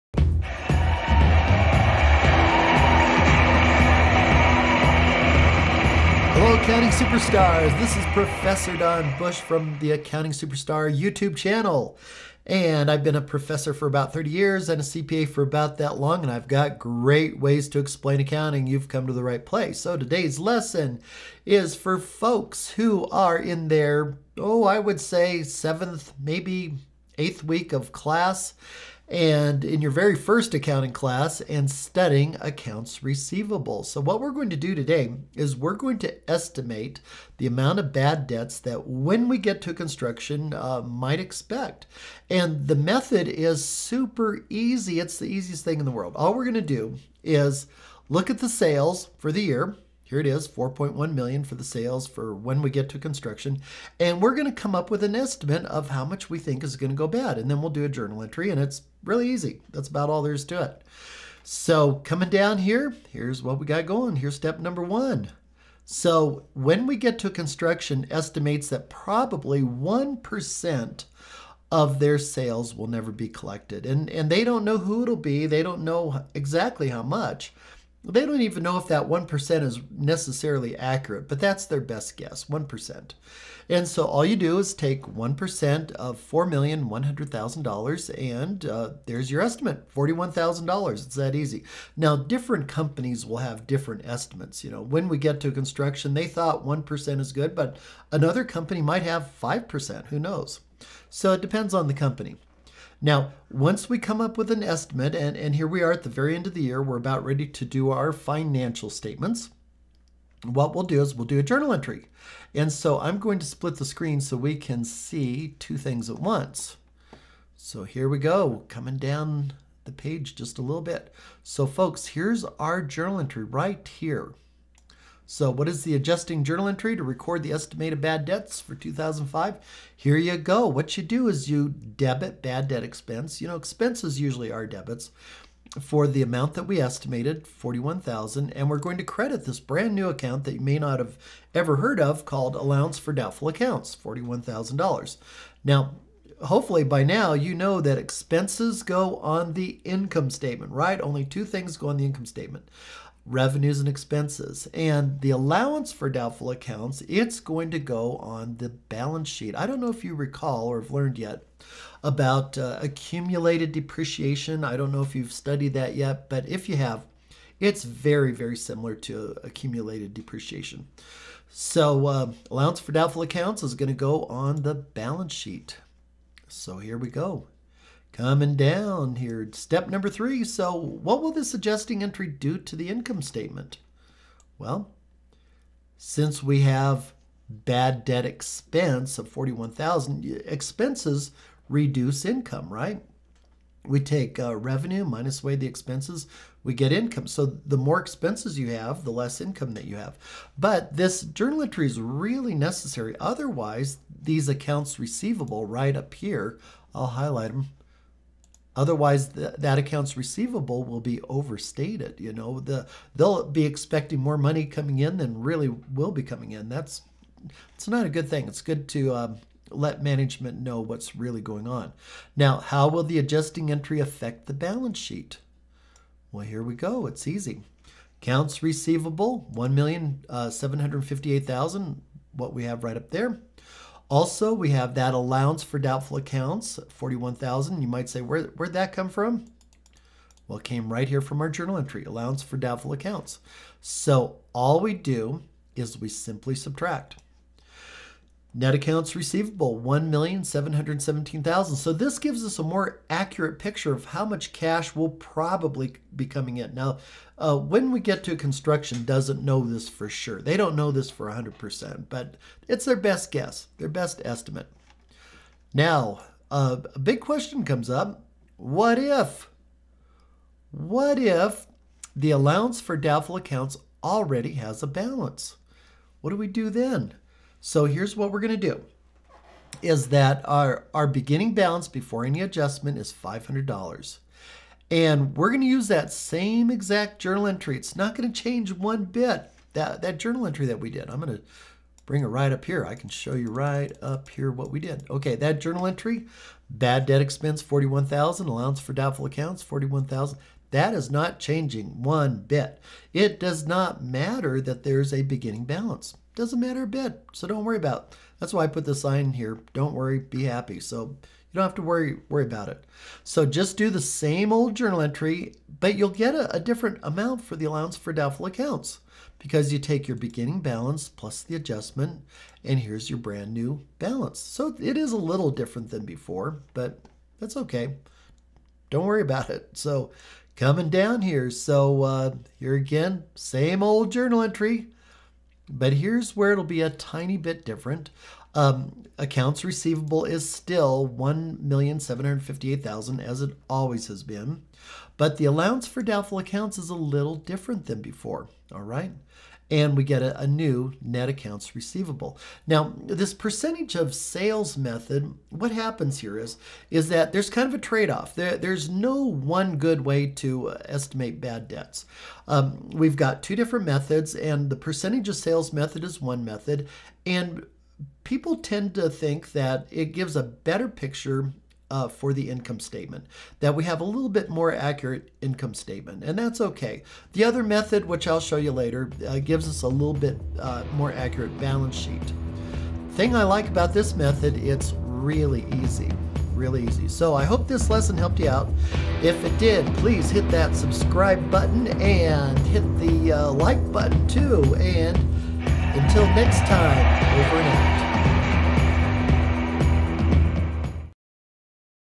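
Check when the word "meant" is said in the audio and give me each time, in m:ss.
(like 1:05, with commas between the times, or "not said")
not said.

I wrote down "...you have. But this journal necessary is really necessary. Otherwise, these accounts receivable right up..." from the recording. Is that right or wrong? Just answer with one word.
wrong.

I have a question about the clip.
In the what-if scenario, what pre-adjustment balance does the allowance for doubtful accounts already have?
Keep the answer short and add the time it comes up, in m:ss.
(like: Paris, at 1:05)
$500, at 4:43.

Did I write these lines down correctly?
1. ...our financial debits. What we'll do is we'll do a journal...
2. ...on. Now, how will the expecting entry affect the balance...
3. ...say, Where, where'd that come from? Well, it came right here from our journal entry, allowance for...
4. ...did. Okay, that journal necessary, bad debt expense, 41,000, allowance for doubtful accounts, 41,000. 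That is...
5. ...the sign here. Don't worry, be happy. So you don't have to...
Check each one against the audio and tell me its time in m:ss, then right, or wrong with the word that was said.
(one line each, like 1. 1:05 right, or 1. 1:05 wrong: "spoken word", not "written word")
1. 1:47 wrong: "statements", not "debits"
2. 3:41 wrong: "adjusting", not "expecting"
3. 3:58 right
4. 4:54 wrong: "entry", not "necessary"
5. 5:08 right.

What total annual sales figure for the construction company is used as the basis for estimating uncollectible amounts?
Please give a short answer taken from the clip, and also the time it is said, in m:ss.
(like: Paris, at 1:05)
4.1 million, at 0:50.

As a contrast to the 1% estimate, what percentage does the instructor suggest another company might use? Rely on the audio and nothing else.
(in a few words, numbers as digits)
5%.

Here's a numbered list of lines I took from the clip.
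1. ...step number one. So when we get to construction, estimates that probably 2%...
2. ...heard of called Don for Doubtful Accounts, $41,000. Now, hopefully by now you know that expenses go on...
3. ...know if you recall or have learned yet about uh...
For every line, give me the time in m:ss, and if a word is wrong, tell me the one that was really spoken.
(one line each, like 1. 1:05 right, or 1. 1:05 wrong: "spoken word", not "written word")
1. 1:04 wrong: "1", not "2"
2. 2:21 wrong: "Allowance", not "Don"
3. 2:39 right.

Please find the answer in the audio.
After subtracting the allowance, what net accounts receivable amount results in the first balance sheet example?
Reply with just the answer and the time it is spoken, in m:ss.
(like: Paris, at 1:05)
1,717,000, at 4:09.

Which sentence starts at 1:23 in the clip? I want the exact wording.
And so all you do is take 1% of $4,100,000, and uh, there's your estimate $41,000.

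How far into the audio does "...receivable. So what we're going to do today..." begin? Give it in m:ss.
0:33.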